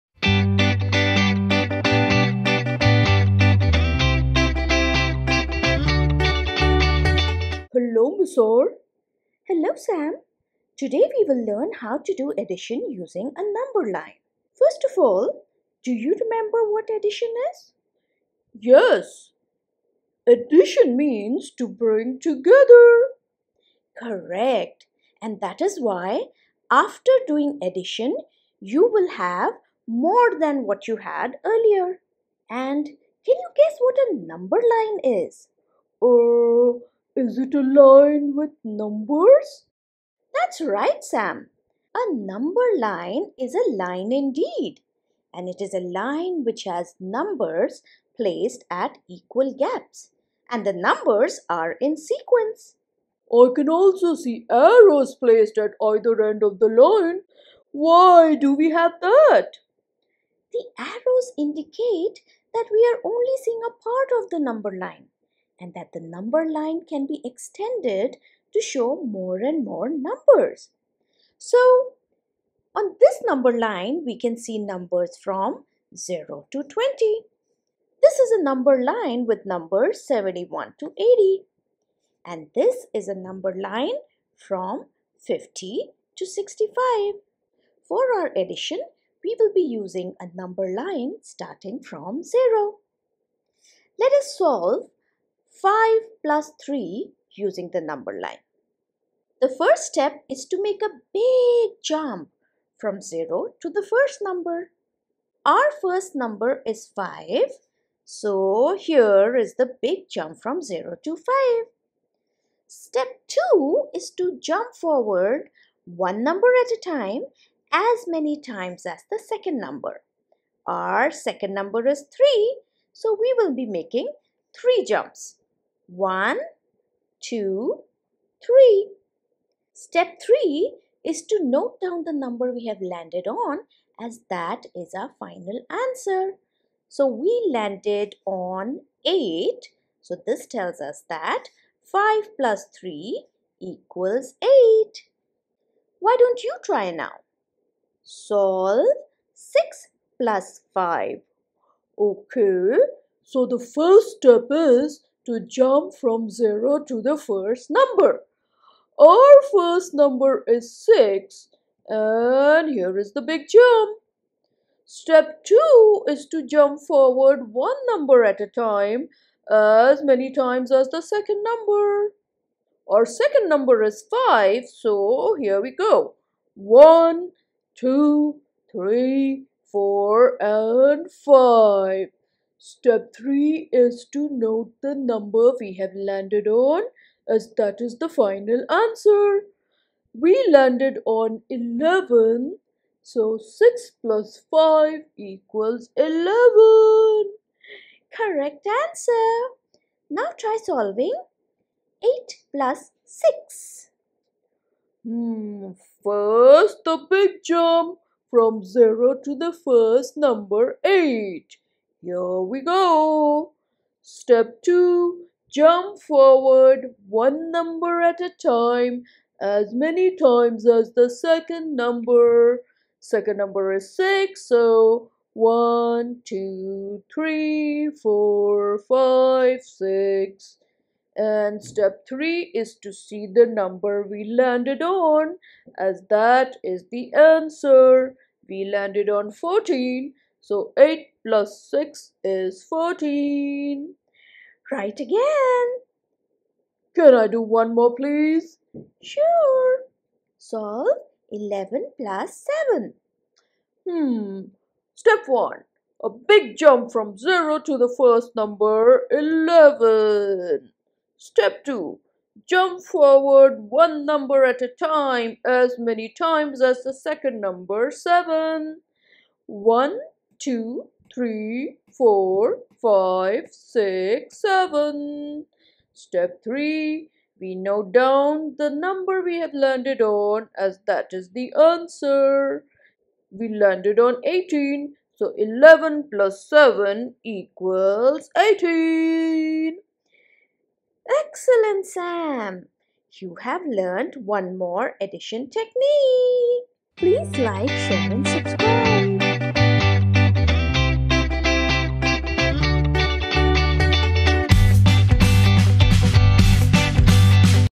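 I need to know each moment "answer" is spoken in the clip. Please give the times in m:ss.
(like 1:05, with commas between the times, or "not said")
2:15, 3:08, 3:18, 3:57, 4:41.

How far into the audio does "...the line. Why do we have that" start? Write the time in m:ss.
0:56.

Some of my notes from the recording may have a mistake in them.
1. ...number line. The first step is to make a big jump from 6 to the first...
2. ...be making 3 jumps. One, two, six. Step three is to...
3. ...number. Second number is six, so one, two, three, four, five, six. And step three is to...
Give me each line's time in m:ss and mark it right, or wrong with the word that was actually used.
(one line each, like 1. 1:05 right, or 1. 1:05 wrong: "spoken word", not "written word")
1. 1:37 wrong: "0", not "6"
2. 2:03 wrong: "three", not "six"
3. 3:41 right.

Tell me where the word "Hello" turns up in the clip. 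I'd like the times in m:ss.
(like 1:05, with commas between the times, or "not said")
0:08.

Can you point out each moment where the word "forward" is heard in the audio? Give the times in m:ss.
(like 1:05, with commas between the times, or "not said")
1:54, 2:46, 3:36, 4:22.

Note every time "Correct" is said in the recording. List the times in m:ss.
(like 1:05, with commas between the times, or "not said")
0:23, 3:18.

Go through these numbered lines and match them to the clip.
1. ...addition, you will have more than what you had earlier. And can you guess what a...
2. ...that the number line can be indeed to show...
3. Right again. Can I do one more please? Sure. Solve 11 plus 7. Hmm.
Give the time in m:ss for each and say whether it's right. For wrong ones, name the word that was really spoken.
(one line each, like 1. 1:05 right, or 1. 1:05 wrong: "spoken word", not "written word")
1. 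0:27 right
2. 1:05 wrong: "extended", not "indeed"
3. 4:04 right.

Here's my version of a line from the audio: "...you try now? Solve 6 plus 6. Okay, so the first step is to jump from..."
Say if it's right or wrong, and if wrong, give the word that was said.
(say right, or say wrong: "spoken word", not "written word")
wrong: "5", not "6".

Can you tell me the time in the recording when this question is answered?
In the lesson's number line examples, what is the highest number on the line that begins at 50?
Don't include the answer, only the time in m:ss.
1:26.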